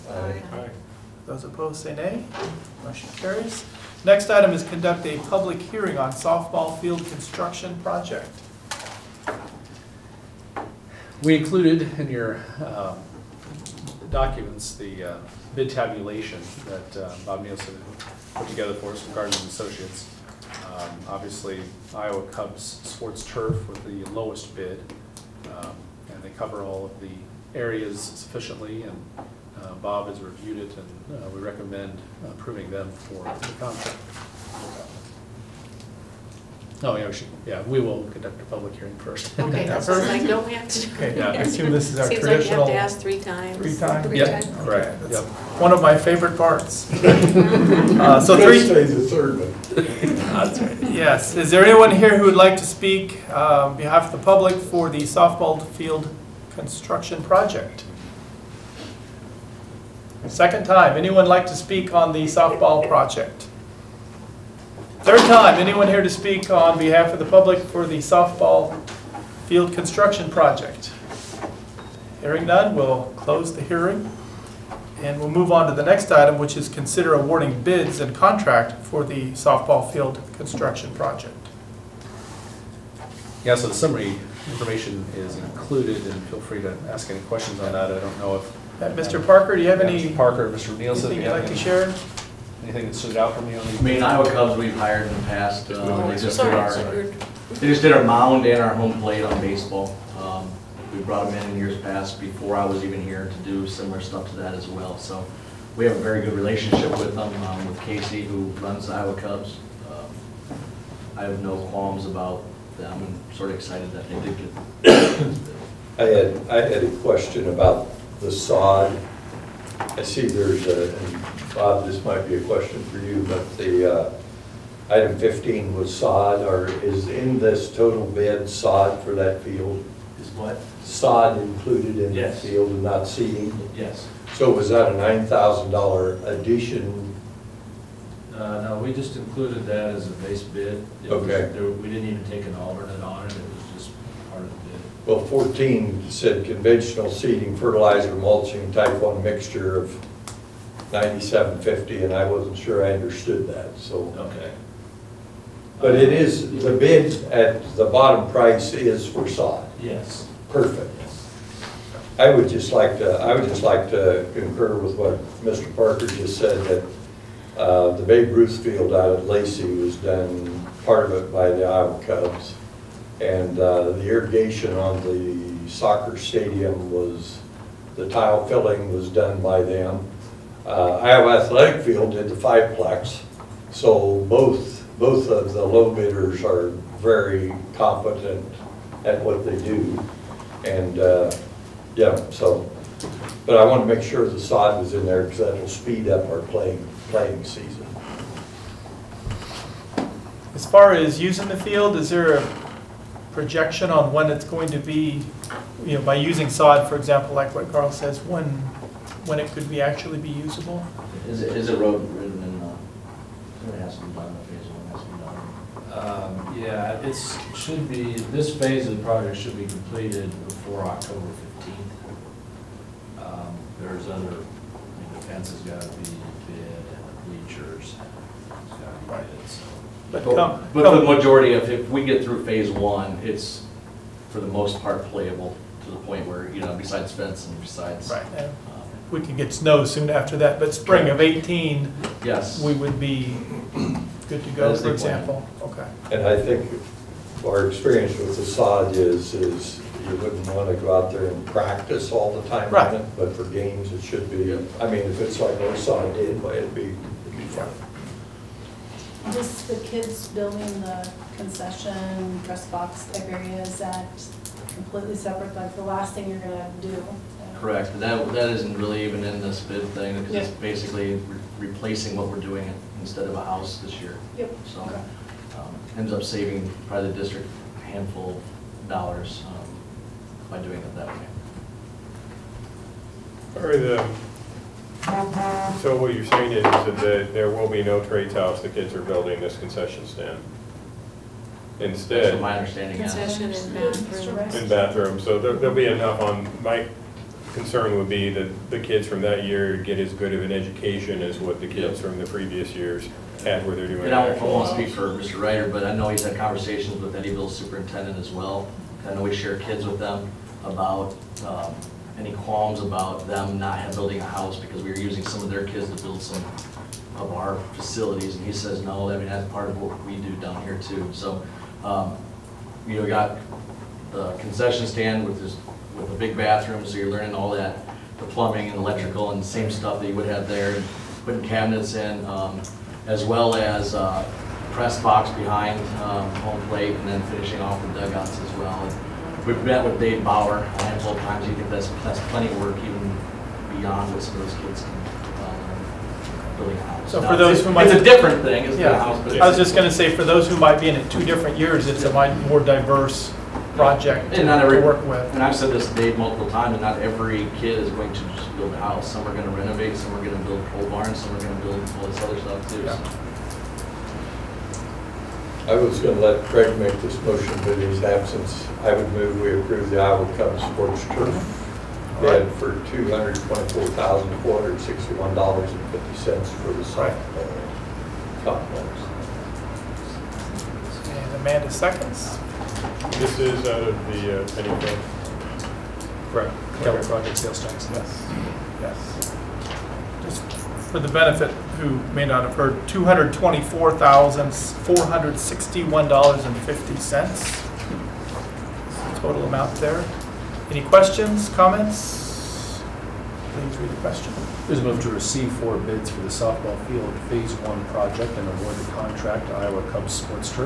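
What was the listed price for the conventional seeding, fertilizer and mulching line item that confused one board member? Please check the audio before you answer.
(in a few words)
$9,750.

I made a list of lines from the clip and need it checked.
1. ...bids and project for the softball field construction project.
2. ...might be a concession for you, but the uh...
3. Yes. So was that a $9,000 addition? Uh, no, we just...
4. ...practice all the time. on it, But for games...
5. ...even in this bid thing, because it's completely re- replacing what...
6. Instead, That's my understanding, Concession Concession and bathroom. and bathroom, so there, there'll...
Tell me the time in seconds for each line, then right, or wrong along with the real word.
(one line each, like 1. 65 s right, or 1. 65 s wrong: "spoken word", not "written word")
1. 77 s wrong: "contract", not "project"
2. 122 s wrong: "question", not "concession"
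3. 133 s right
4. 251 s right
5. 269 s wrong: "basically", not "completely"
6. 291 s right.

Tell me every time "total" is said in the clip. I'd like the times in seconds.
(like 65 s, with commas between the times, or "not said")
127 s, 399 s.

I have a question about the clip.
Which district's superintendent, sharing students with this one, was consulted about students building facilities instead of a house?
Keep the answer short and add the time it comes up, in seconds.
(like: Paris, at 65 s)
Eddyville, at 307 s.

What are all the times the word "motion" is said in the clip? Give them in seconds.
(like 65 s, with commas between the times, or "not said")
2 s, 367 s.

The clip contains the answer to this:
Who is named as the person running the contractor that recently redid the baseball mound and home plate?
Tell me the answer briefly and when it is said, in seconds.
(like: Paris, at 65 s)
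Casey, at 107 s.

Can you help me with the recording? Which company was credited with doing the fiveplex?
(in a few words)
Iowa Athletic Field.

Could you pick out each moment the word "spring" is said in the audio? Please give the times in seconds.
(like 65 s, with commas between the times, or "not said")
240 s.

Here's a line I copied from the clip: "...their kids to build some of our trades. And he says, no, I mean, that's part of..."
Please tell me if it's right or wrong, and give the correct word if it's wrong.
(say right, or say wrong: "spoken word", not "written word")
wrong: "facilities", not "trades".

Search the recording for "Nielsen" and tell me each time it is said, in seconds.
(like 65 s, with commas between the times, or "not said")
17 s, 90 s.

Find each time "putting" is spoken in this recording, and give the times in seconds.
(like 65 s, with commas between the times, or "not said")
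331 s.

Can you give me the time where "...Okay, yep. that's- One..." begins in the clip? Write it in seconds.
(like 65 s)
45 s.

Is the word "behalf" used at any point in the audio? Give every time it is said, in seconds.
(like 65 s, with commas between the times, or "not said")
53 s, 66 s.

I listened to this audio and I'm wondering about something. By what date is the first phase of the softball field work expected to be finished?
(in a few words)
October 15th.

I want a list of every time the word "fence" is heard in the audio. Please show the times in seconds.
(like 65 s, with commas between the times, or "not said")
225 s, 237 s.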